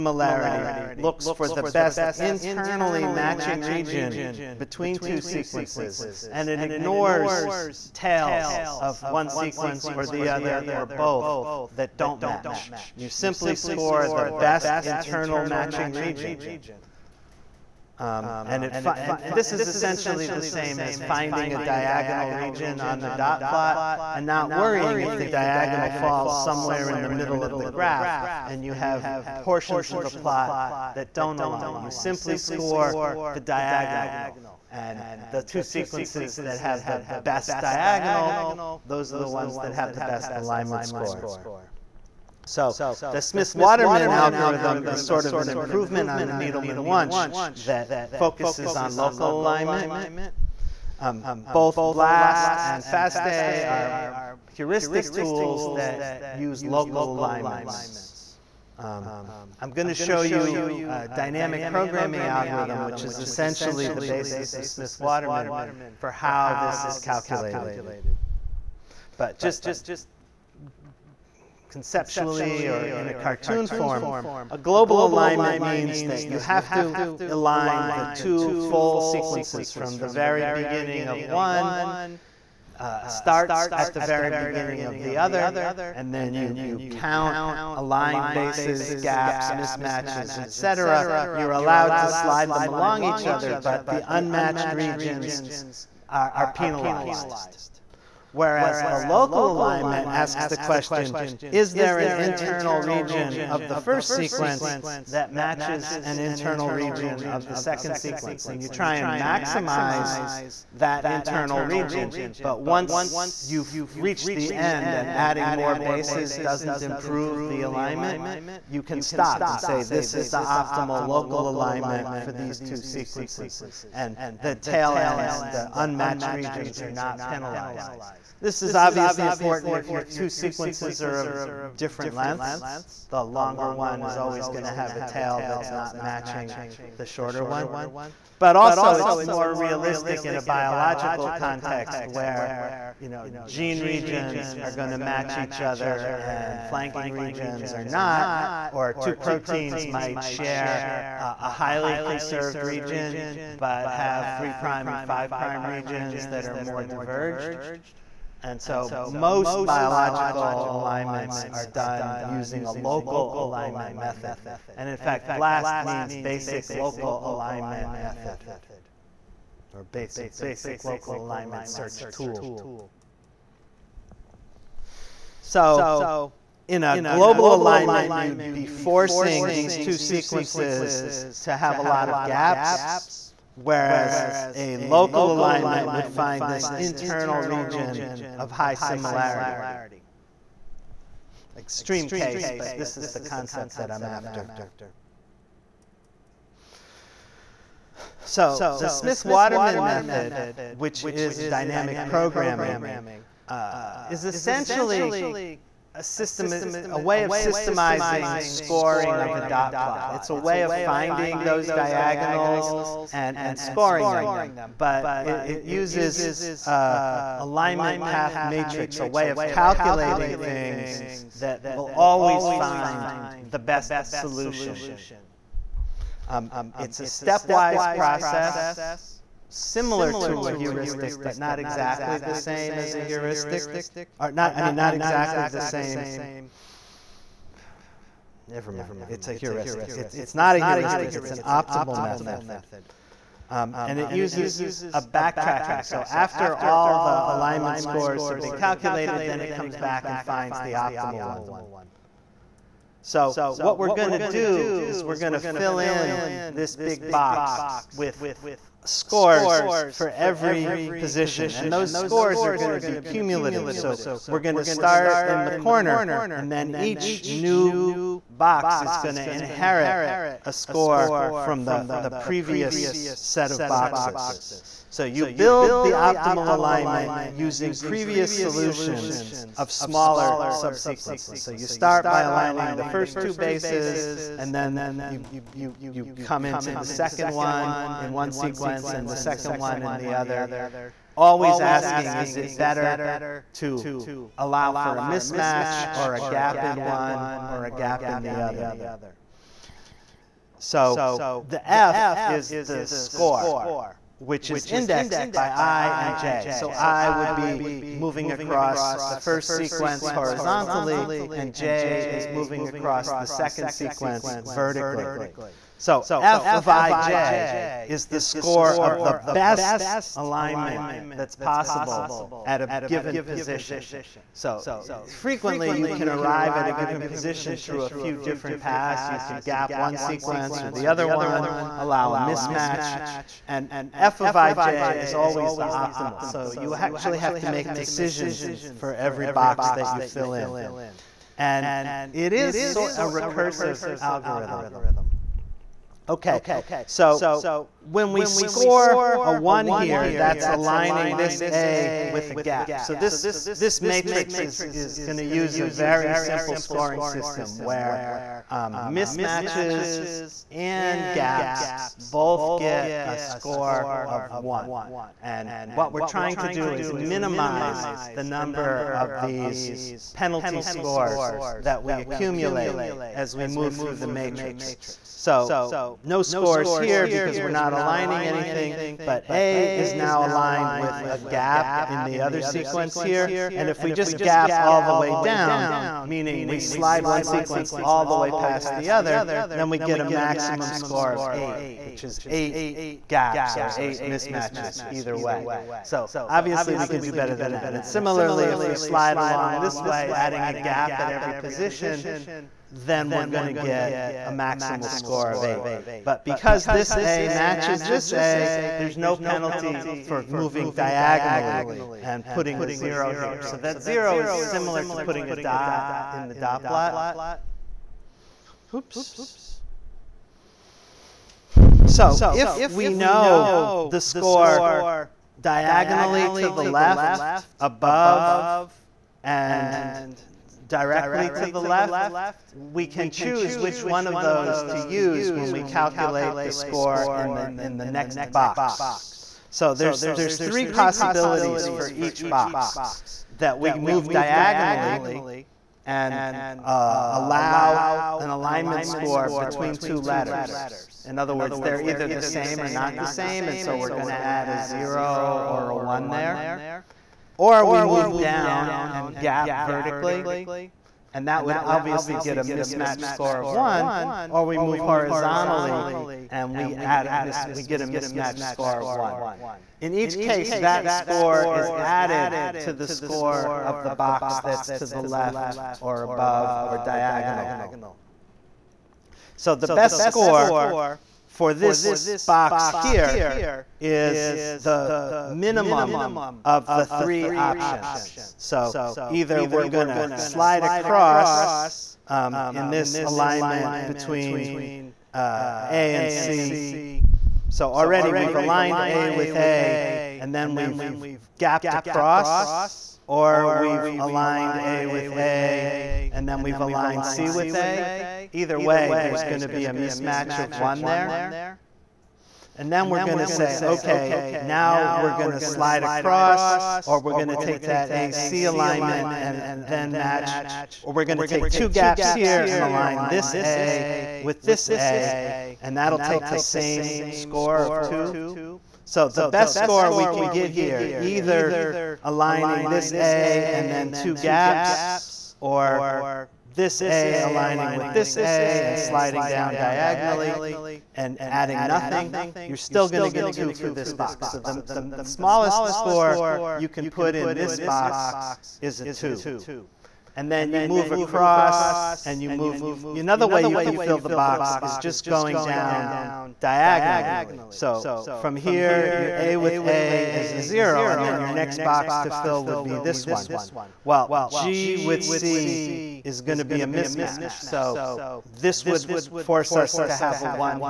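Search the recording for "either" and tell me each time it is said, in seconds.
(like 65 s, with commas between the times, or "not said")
394 s, 451 s, 489 s, 508 s, 530 s.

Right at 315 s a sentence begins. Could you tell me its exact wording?
So f of ij is the score of the best alignment that's possible at a given position.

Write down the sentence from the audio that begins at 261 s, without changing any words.
And those scores are going to be cumulative.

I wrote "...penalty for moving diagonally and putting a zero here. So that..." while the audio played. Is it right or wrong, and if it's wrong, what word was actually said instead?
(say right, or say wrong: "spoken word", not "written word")
right.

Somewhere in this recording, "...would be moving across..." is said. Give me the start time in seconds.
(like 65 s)
307 s.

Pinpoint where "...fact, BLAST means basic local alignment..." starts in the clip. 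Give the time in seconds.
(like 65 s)
164 s.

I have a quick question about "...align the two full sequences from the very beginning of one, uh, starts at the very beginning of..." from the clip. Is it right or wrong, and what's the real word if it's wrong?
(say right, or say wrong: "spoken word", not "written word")
right.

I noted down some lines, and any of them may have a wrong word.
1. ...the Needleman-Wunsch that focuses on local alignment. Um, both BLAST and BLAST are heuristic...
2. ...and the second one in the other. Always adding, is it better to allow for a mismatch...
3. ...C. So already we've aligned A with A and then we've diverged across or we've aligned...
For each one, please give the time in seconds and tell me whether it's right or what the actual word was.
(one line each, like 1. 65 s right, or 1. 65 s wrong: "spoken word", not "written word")
1. 46 s wrong: "FASTA", not "BLAST"
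2. 288 s wrong: "asking", not "adding"
3. 496 s wrong: "gapped", not "diverged".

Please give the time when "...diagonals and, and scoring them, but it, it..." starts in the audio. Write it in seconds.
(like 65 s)
211 s.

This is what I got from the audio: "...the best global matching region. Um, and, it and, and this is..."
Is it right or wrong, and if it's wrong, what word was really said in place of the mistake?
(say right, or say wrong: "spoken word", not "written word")
wrong: "internal", not "global".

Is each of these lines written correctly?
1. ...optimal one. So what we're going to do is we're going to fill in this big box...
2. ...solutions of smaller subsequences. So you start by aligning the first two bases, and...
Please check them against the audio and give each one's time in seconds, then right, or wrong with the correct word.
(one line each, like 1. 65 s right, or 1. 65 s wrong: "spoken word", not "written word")
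1. 250 s right
2. 278 s right.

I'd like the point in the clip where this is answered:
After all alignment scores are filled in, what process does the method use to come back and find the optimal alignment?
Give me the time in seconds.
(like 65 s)
245 s.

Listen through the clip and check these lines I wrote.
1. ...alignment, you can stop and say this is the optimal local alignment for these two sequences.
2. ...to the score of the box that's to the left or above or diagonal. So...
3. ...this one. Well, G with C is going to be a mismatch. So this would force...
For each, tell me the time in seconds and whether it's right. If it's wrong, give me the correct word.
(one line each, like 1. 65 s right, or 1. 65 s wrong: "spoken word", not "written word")
1. 117 s right
2. 472 s right
3. 562 s right.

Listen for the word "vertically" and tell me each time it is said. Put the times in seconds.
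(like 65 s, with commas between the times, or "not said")
314 s, 459 s.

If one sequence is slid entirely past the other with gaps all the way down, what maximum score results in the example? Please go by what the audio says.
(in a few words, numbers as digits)
8.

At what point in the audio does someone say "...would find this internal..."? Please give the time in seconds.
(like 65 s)
185 s.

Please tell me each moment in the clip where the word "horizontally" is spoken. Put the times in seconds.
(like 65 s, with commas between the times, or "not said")
310 s, 464 s.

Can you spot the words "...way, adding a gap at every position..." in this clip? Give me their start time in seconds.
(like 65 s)
399 s.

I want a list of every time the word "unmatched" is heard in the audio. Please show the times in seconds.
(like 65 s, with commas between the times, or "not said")
94 s, 125 s.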